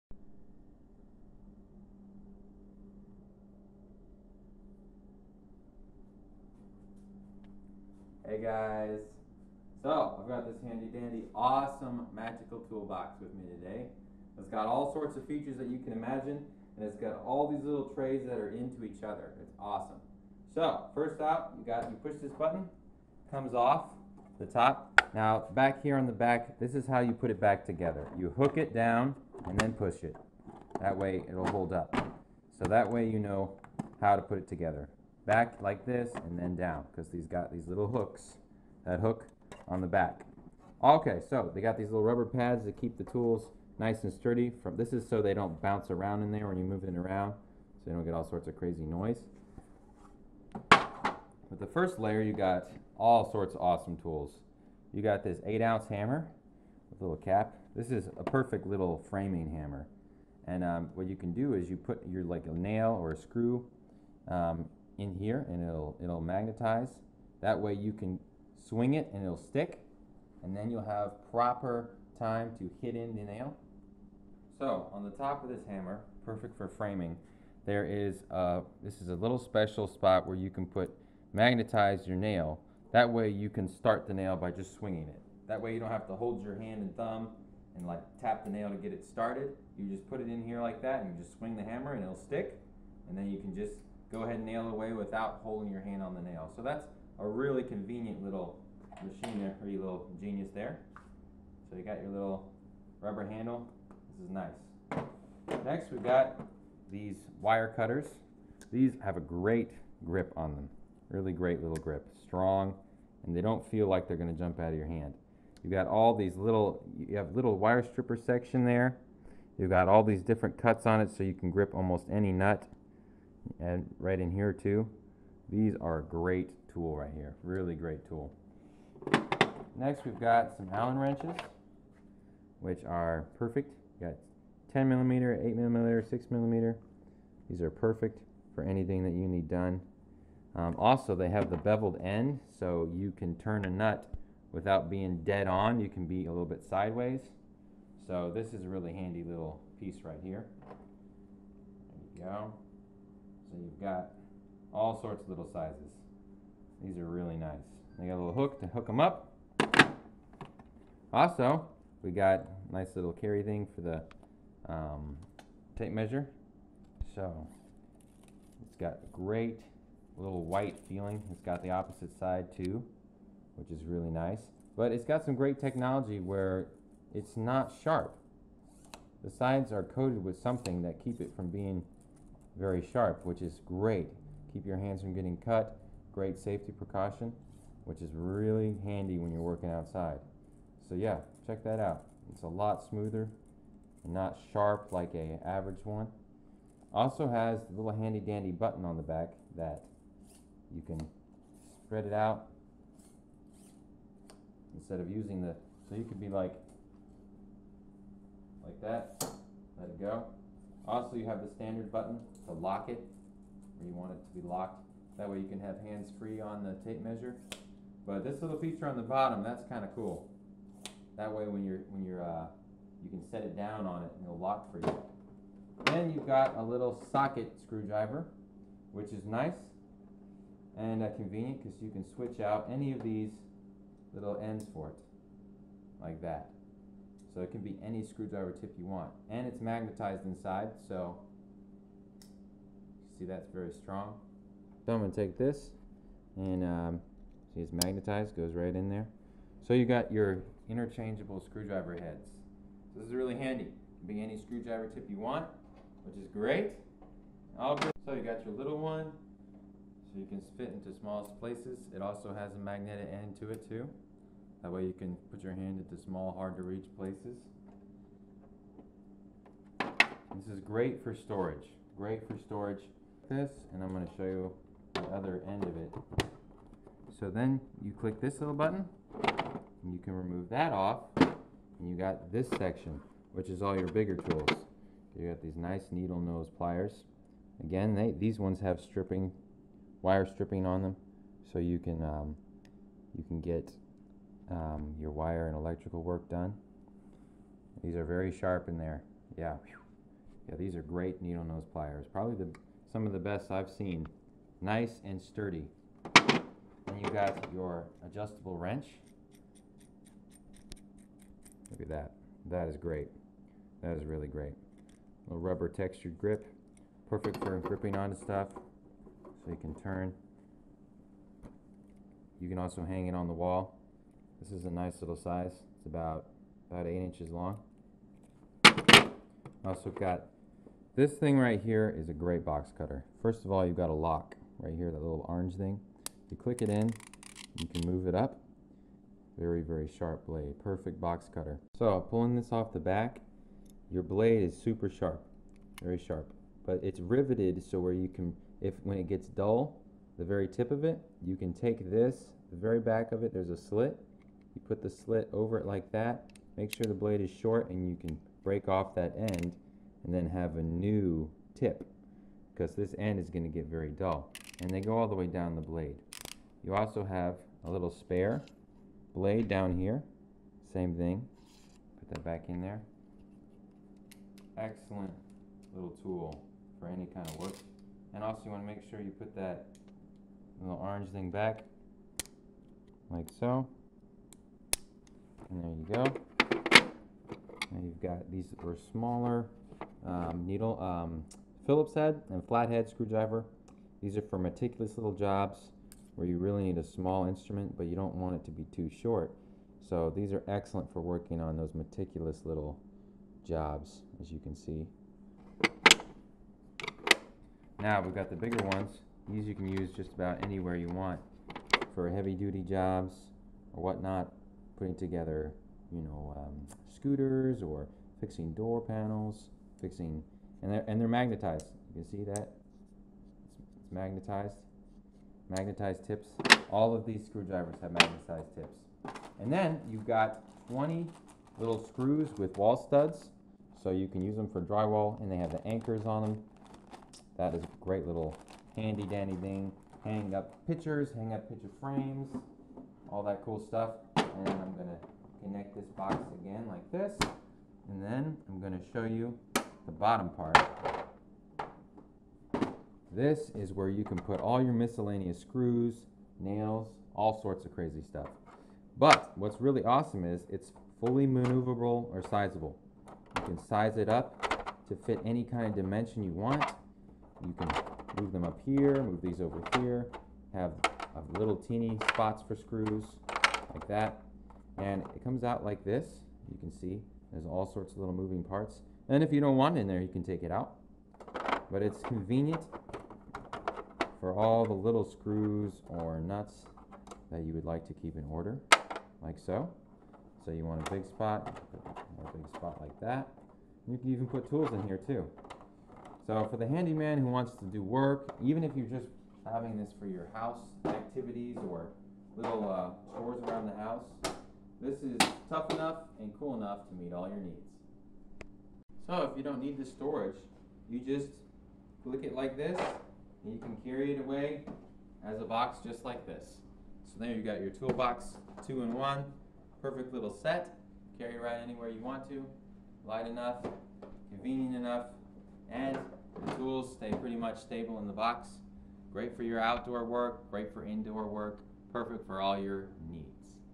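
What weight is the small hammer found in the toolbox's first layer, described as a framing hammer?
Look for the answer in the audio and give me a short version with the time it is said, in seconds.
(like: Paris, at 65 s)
8 ounce, at 55 s.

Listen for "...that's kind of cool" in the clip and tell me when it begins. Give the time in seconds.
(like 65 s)
219 s.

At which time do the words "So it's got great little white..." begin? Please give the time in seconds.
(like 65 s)
167 s.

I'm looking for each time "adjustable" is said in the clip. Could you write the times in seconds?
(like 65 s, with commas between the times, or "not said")
308 s.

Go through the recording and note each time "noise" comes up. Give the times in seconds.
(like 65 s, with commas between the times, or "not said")
48 s.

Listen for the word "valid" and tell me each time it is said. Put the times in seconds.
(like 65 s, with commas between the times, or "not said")
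not said.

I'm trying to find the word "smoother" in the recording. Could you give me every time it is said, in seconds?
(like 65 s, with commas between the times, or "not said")
192 s.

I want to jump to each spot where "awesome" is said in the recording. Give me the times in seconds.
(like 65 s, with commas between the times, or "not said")
11 s, 19 s, 53 s, 459 s.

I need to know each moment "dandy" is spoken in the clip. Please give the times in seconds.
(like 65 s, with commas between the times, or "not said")
10 s, 198 s, 439 s.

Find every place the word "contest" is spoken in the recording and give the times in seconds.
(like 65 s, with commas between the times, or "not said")
not said.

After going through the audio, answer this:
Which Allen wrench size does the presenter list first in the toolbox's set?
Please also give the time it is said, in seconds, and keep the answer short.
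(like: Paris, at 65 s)
10 millimeter, at 134 s.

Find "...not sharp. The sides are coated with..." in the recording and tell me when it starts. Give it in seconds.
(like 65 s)
177 s.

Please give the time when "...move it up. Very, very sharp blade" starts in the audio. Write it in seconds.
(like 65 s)
337 s.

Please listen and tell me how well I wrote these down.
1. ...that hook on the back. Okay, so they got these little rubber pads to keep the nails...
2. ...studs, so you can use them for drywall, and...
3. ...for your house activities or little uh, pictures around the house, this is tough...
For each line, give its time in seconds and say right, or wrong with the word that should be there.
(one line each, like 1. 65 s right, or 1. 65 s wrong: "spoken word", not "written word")
1. 38 s wrong: "tools", not "nails"
2. 432 s right
3. 499 s wrong: "chores", not "pictures".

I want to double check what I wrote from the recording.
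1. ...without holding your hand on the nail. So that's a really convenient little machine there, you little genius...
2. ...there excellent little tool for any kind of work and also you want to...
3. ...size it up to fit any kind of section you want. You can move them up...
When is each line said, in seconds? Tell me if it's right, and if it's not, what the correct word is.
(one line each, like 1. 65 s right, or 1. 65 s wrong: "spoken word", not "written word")
1. 94 s right
2. 372 s right
3. 463 s wrong: "dimension", not "section".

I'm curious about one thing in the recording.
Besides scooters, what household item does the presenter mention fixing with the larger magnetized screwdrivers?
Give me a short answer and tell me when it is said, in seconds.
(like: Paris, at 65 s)
door panels, at 418 s.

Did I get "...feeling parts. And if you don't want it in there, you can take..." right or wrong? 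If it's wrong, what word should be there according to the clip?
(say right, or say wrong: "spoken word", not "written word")
wrong: "moving", not "feeling".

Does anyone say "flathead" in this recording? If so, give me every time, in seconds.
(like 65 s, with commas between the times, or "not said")
392 s.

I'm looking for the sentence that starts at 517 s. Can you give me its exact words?
So there you got your toolbox, two in one, perfect little set.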